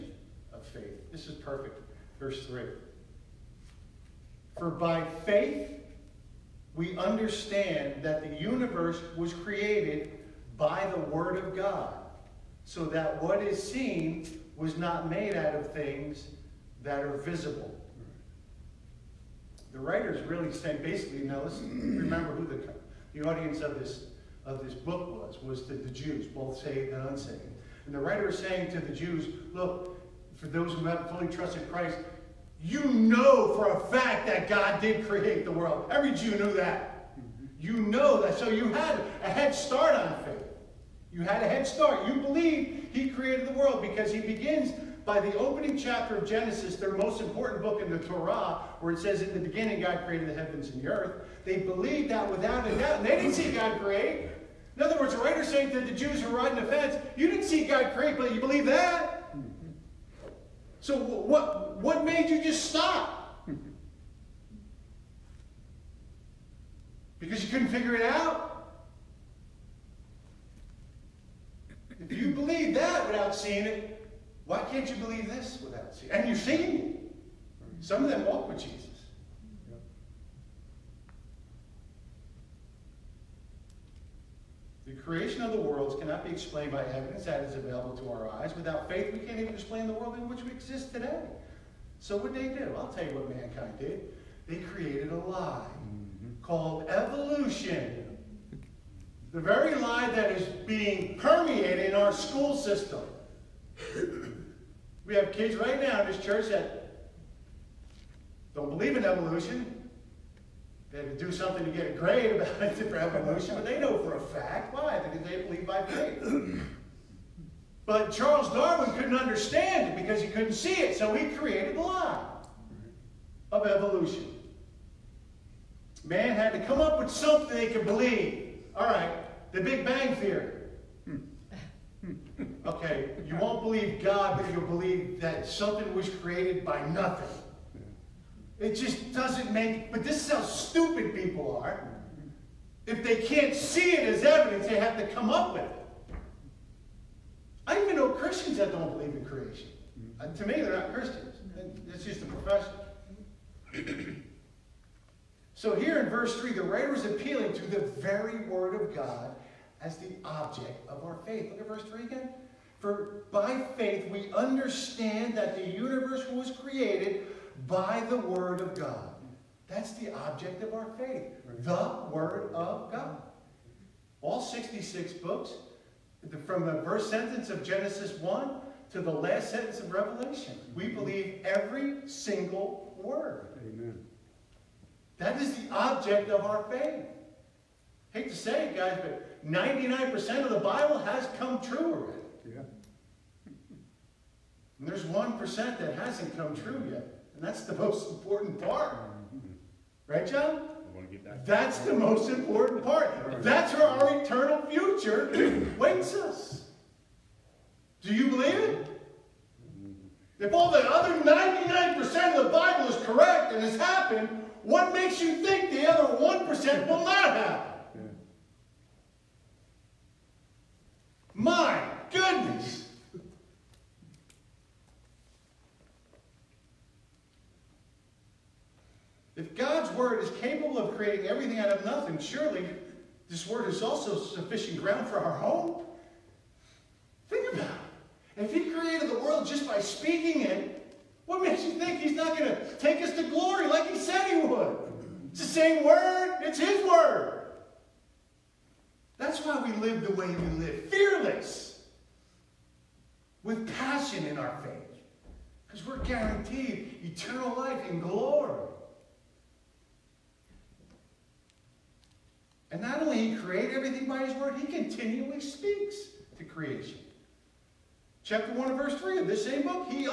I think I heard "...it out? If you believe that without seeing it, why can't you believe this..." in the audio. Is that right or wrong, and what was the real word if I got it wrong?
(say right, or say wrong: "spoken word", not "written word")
right.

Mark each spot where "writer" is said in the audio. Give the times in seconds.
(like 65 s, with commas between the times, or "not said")
19 s, 27 s, 55 s, 156 s.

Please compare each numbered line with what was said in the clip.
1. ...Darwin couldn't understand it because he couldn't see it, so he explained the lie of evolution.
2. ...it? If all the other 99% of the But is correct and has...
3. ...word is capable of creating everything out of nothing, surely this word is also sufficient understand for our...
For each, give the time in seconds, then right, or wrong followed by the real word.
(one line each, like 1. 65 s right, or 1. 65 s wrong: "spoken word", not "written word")
1. 118 s wrong: "created", not "explained"
2. 208 s wrong: "Bible", not "But"
3. 229 s wrong: "ground", not "understand".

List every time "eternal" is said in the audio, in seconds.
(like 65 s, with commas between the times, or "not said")
204 s, 257 s.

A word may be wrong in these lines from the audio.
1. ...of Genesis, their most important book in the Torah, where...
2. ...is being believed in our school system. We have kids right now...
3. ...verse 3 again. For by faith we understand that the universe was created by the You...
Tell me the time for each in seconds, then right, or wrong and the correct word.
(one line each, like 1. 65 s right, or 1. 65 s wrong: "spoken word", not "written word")
1. 46 s right
2. 100 s wrong: "permeated", not "believed"
3. 161 s wrong: "Word", not "You".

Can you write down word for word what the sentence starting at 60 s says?
So what, what made you just stop?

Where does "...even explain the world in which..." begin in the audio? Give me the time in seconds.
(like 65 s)
89 s.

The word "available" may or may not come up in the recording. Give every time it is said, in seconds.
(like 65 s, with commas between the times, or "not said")
87 s.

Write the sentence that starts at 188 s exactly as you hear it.
I hate to say it, guys, but 99% of the Bible has come true already.